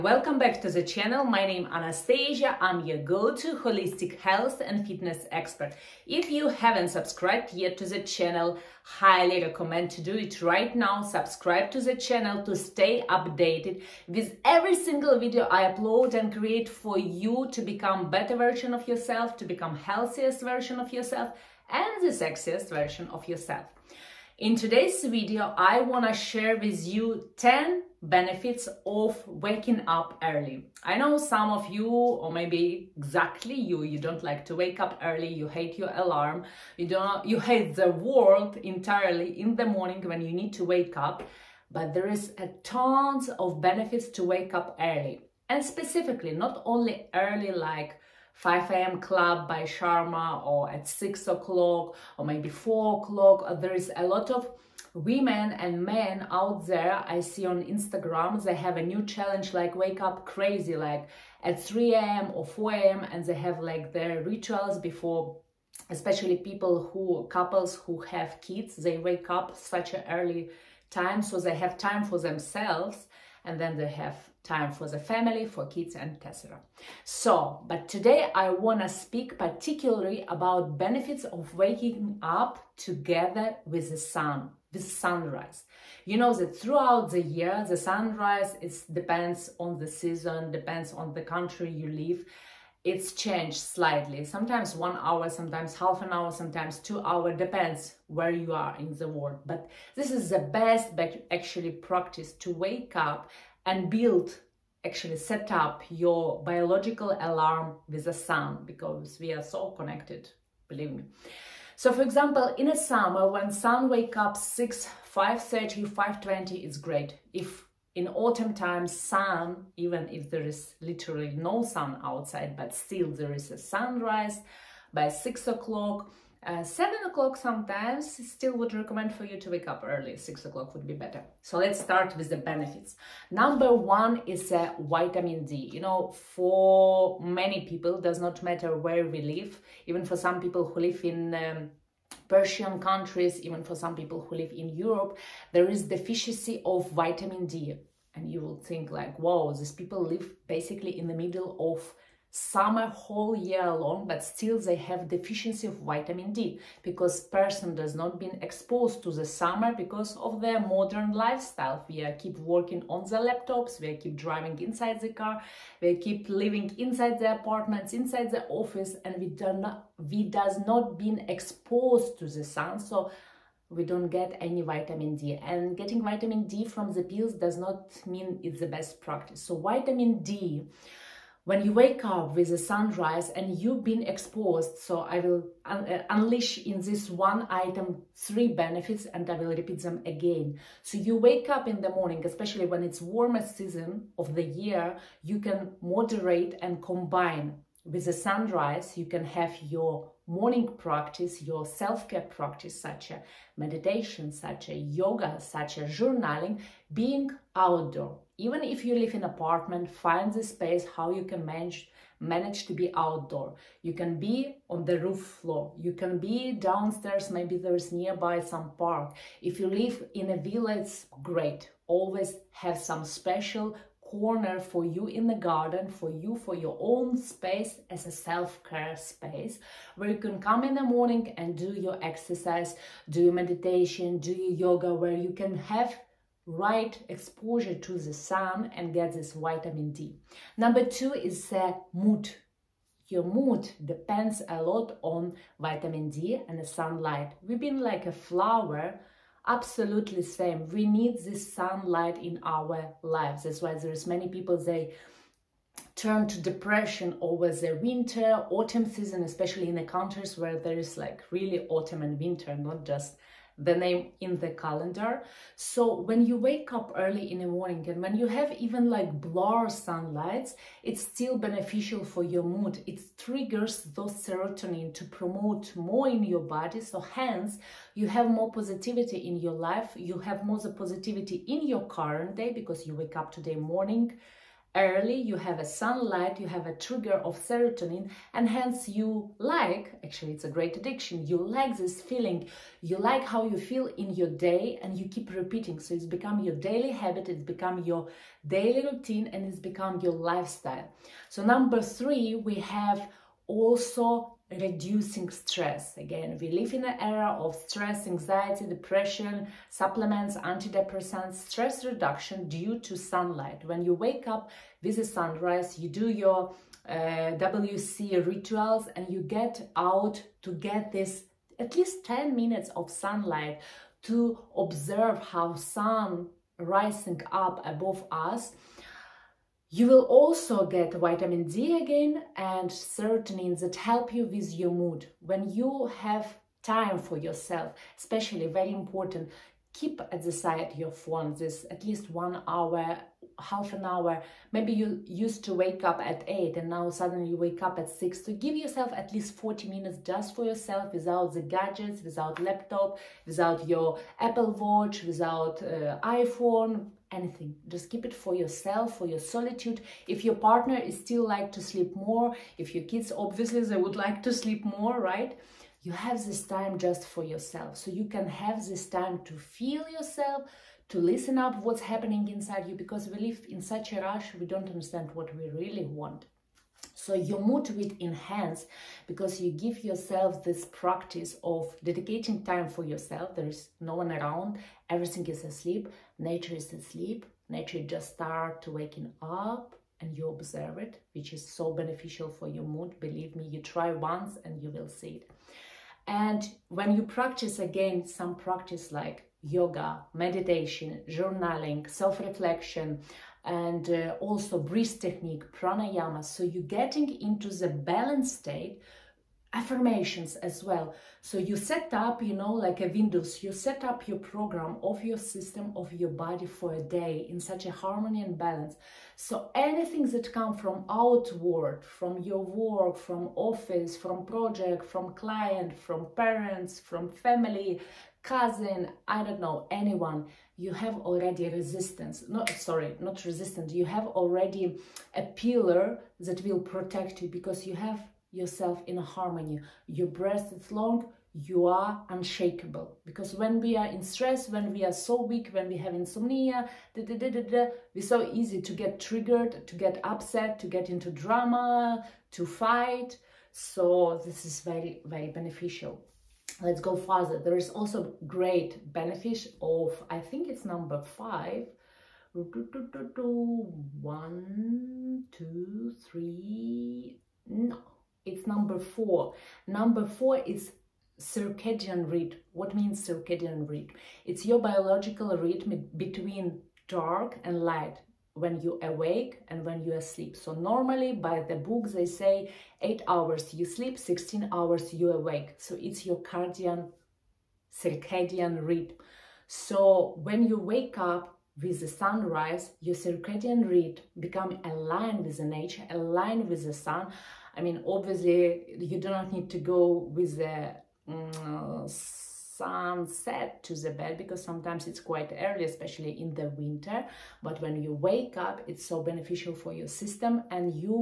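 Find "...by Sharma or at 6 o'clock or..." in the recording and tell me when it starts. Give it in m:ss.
0:49.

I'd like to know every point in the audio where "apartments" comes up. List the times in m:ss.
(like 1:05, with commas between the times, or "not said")
2:47, 3:29.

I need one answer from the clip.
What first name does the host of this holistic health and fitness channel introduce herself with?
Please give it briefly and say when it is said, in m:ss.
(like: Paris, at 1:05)
Anastasia, at 0:01.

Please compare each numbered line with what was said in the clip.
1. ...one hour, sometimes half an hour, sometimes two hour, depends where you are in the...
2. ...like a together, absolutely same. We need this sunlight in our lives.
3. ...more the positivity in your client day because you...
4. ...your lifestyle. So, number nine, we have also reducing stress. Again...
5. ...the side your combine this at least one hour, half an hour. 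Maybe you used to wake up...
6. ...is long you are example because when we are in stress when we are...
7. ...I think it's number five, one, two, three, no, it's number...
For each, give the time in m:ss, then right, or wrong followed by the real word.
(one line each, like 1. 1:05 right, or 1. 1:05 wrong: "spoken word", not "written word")
1. 1:34 right
2. 4:07 wrong: "flower", not "together"
3. 4:40 wrong: "current", not "client"
4. 4:59 wrong: "three", not "nine"
5. 5:40 wrong: "phone", not "combine"
6. 7:20 wrong: "unshakable", not "example"
7. 7:40 right.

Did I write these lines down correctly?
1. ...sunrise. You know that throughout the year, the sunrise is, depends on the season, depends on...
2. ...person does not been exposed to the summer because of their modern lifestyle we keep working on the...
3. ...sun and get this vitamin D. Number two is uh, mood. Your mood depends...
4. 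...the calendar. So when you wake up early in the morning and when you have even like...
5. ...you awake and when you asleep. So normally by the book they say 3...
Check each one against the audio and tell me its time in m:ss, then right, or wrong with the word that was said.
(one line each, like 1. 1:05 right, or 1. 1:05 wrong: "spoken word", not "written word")
1. 1:24 right
2. 2:37 right
3. 3:58 right
4. 4:24 right
5. 7:58 wrong: "8", not "3".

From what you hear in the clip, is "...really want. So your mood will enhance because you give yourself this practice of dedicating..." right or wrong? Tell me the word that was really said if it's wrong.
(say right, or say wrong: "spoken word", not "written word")
right.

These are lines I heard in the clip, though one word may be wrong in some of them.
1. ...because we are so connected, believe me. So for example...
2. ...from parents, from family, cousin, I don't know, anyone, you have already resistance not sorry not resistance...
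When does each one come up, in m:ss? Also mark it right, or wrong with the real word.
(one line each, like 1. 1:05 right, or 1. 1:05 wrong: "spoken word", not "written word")
1. 1:48 right
2. 7:05 right.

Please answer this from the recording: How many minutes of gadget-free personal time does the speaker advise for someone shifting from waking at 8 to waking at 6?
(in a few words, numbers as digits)
40.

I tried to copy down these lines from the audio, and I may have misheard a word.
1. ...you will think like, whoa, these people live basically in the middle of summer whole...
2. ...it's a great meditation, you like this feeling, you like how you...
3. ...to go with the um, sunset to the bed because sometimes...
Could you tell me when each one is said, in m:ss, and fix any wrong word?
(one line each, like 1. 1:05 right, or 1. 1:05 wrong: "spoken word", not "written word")
1. 2:28 right
2. 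4:50 wrong: "addiction", not "meditation"
3. 8:19 right.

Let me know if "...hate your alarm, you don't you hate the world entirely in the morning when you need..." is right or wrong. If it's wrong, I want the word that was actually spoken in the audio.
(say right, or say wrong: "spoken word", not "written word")
right.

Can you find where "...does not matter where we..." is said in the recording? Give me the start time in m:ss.
2:17.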